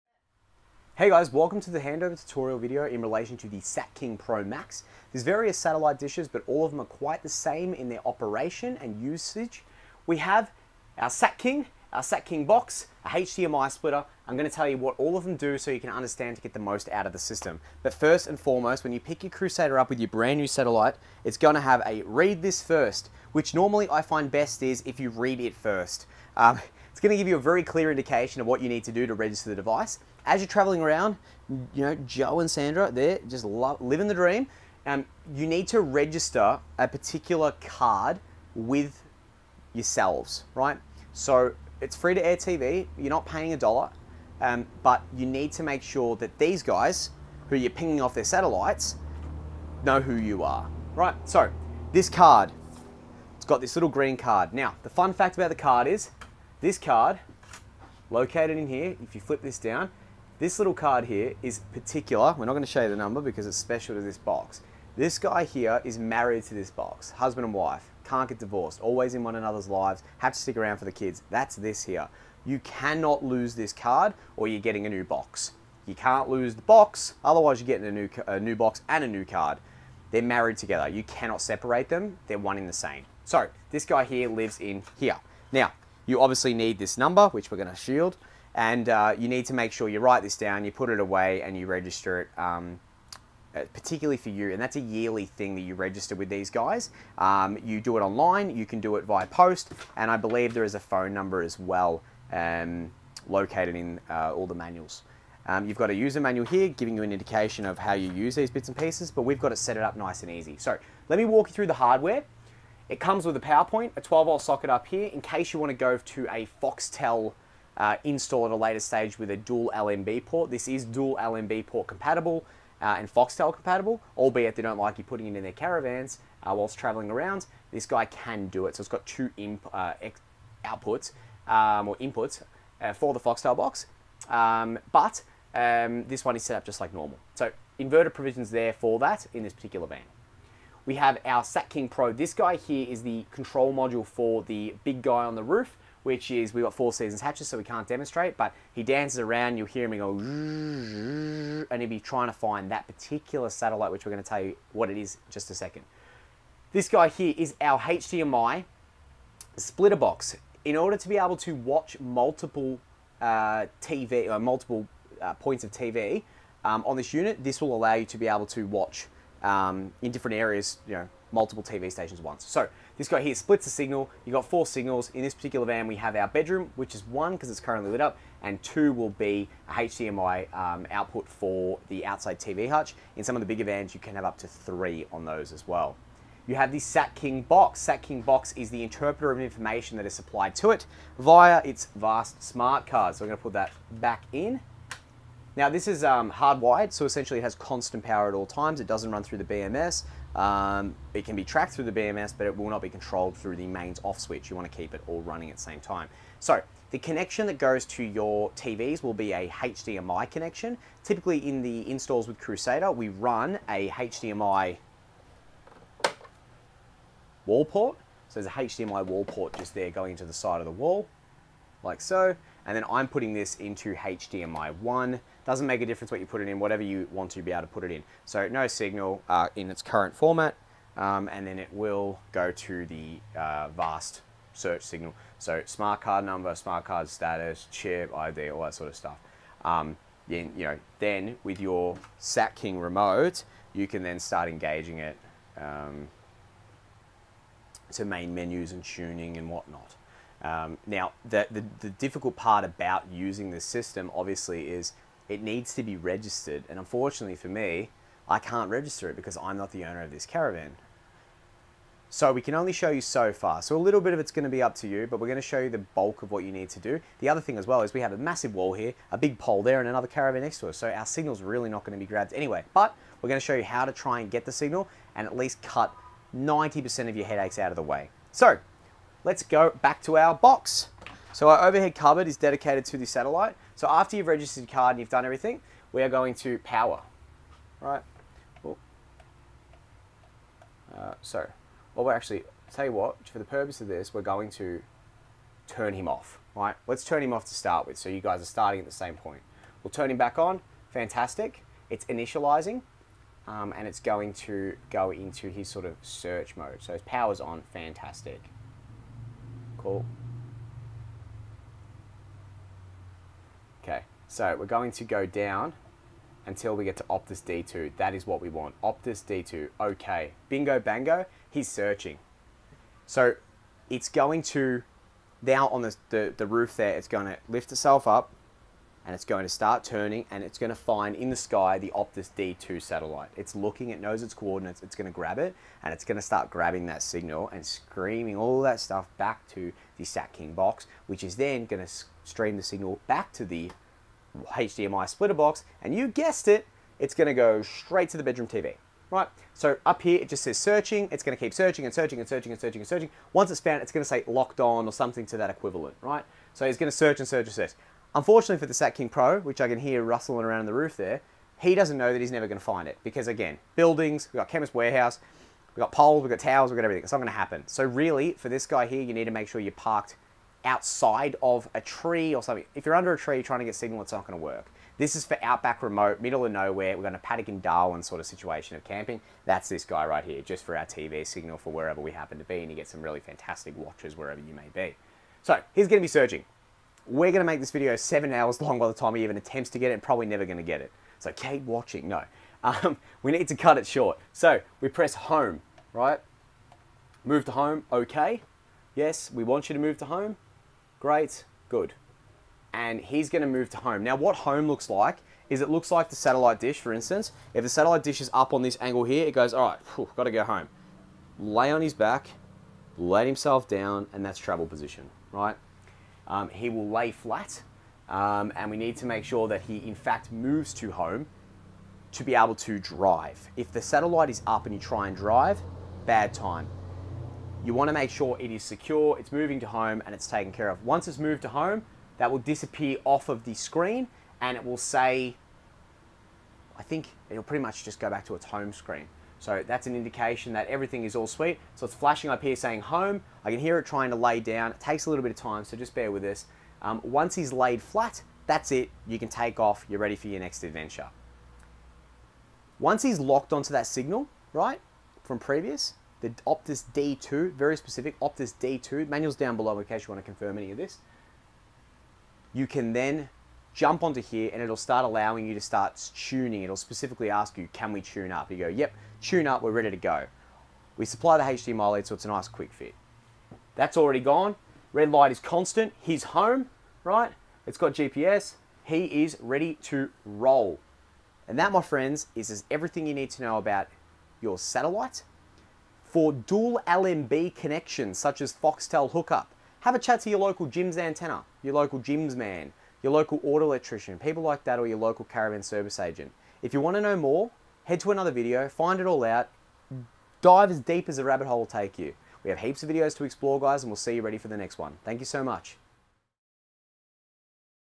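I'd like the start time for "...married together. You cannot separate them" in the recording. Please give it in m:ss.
1:20.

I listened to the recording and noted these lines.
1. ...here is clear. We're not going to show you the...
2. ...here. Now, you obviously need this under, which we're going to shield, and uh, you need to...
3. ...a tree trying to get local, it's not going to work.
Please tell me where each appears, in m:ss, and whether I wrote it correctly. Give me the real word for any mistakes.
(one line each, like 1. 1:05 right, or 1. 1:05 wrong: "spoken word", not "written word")
1. 1:01 wrong: "particular", not "clear"
2. 1:24 wrong: "number", not "under"
3. 6:13 wrong: "signal", not "local".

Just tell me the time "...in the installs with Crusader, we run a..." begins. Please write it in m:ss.
3:31.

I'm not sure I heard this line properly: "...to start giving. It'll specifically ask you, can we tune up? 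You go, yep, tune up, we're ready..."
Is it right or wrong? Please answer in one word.
wrong.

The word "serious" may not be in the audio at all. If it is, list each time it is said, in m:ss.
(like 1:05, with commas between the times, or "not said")
not said.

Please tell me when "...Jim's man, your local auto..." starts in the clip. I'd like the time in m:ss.
8:11.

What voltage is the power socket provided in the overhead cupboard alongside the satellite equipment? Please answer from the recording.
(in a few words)
12 volt.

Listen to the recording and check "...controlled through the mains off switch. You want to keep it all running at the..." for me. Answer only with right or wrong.
right.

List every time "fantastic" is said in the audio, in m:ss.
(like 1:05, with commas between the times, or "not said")
5:00, 5:07, 6:23.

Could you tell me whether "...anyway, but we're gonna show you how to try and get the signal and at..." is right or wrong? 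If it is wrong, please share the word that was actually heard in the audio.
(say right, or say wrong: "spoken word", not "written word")
right.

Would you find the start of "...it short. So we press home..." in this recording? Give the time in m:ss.
6:33.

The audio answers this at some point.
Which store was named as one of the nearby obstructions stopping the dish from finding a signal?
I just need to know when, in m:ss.
6:04.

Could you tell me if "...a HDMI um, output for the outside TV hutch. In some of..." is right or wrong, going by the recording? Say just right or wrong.
right.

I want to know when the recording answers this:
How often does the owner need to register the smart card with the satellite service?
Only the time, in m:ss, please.
1:34.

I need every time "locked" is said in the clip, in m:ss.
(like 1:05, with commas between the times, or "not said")
5:54, 7:33.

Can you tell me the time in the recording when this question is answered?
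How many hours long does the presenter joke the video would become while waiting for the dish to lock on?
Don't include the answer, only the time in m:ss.
6:27.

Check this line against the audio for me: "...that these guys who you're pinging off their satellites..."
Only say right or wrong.
right.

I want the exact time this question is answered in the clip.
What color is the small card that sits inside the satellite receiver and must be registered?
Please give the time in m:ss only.
0:53.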